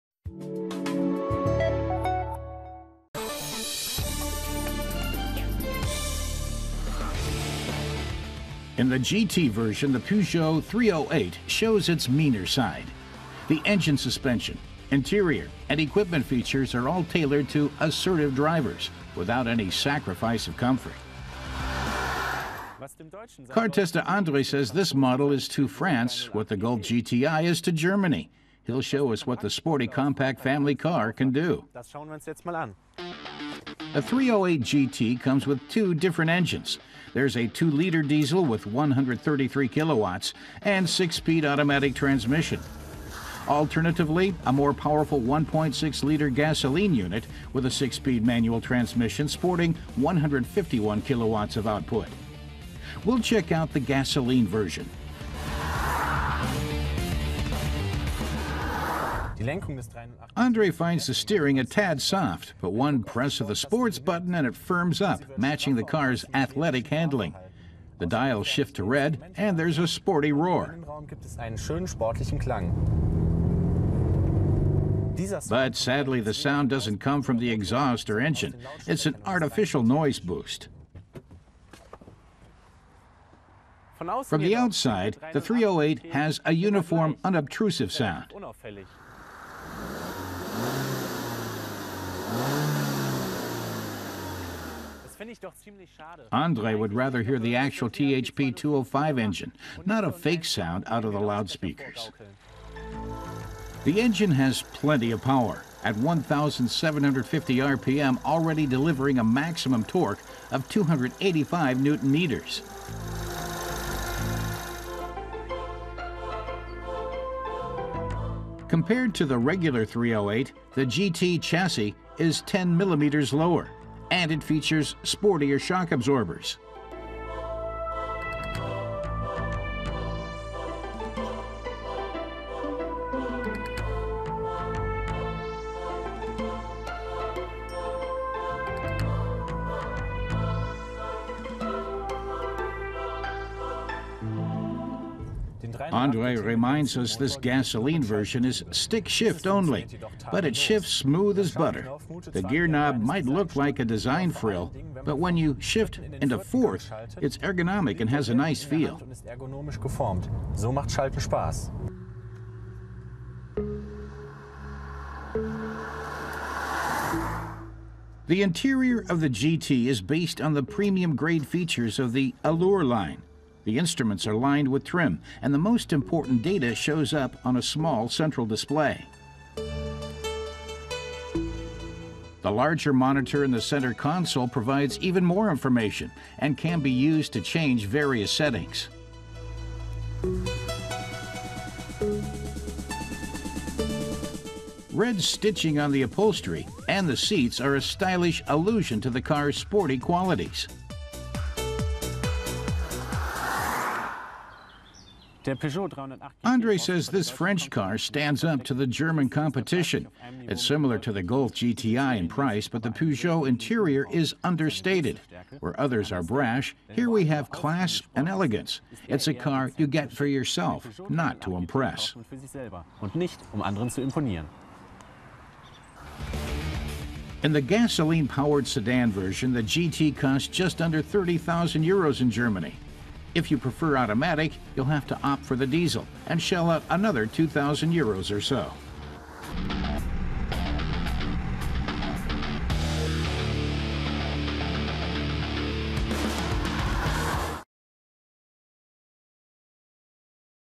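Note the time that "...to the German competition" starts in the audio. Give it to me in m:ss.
3:28.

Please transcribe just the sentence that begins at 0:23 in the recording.
Car tester Andre says this model is to France what the Golf GTI is to Germany.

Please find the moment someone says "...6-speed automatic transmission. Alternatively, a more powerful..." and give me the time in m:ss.
0:40.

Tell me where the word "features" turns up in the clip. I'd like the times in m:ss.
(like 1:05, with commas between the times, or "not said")
0:16, 2:04, 2:51.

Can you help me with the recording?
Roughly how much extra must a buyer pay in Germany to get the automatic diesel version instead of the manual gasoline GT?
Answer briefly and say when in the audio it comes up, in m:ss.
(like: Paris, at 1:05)
2,000 euros, at 3:57.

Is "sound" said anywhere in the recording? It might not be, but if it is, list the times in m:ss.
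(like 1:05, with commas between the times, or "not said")
1:16, 1:27, 1:40.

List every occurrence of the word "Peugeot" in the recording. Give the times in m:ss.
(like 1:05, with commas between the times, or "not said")
0:09, 3:32.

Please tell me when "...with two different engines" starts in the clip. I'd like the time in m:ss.
0:35.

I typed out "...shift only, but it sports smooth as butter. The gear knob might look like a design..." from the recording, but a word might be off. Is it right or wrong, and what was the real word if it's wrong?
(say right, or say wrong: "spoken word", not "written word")
wrong: "shifts", not "sports".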